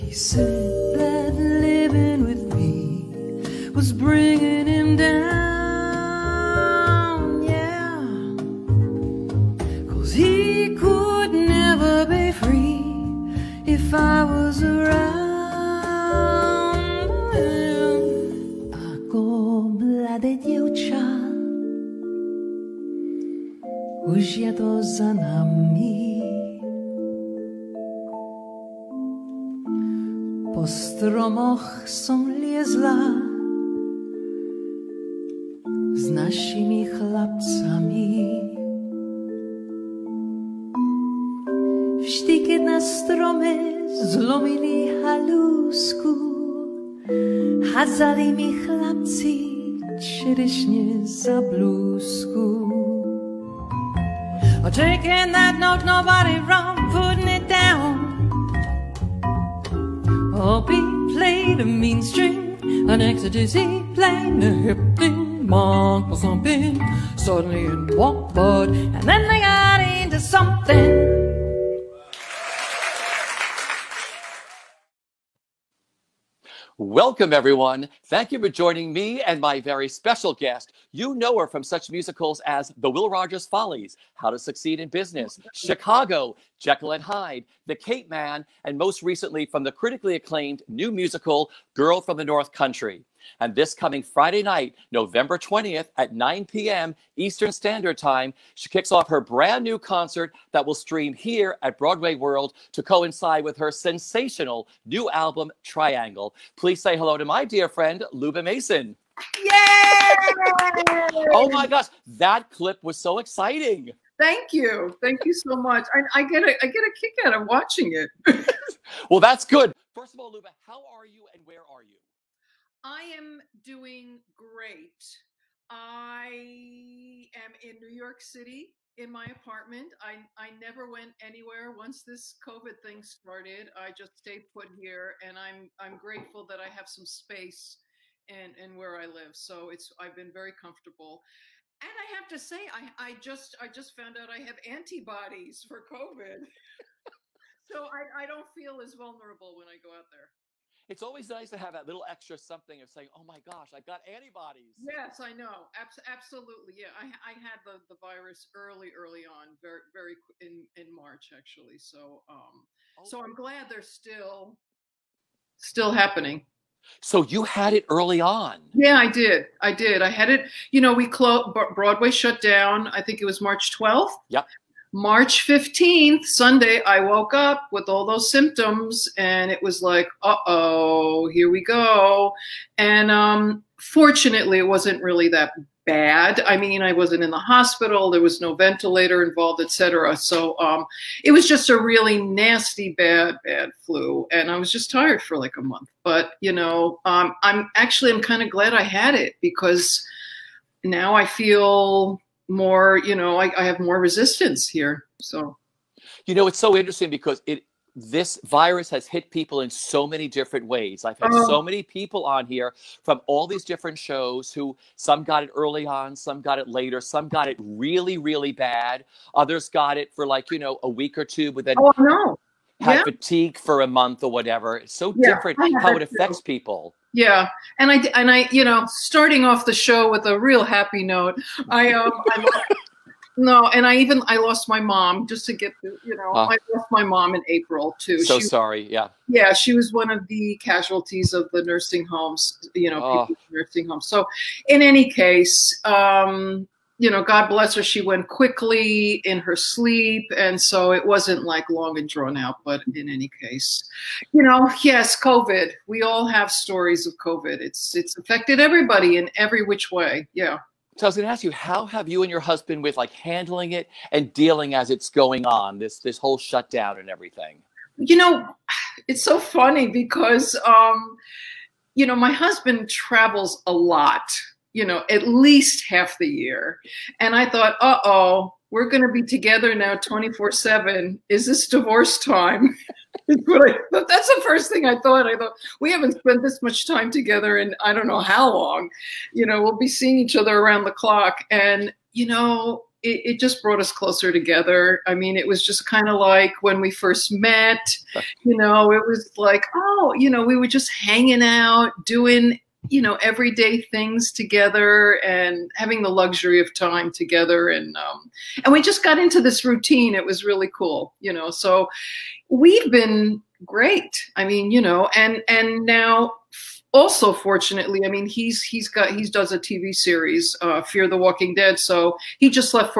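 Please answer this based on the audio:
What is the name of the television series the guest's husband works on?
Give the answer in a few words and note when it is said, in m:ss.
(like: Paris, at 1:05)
Fear the Walking Dead, at 5:20.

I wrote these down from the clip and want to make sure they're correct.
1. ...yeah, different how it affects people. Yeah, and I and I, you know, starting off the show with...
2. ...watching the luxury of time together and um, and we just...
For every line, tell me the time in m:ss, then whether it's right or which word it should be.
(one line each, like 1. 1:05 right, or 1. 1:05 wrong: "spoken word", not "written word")
1. 3:45 right
2. 5:05 wrong: "having", not "watching".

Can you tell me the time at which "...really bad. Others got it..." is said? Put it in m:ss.
3:38.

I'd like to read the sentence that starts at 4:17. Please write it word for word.
It's, it's affected everybody in every which way.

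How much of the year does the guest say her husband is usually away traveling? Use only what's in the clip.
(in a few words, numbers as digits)
At least half the year.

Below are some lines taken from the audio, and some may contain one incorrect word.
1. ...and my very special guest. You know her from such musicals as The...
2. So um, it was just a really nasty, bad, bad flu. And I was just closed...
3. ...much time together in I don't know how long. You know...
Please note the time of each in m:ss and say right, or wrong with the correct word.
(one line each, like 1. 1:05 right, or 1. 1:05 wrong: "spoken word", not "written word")
1. 1:19 right
2. 3:10 wrong: "tired", not "closed"
3. 4:46 right.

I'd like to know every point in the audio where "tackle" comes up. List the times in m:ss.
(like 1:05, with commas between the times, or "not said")
not said.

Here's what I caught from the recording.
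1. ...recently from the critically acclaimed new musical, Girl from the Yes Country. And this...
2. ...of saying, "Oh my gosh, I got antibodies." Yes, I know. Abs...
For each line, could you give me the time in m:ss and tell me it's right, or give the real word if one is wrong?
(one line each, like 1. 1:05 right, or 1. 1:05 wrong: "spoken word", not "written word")
1. 1:29 wrong: "North", not "Yes"
2. 2:32 right.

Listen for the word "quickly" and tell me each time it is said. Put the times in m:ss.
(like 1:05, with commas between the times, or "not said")
4:08.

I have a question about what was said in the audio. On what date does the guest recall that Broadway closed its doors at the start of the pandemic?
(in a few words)
March 12th.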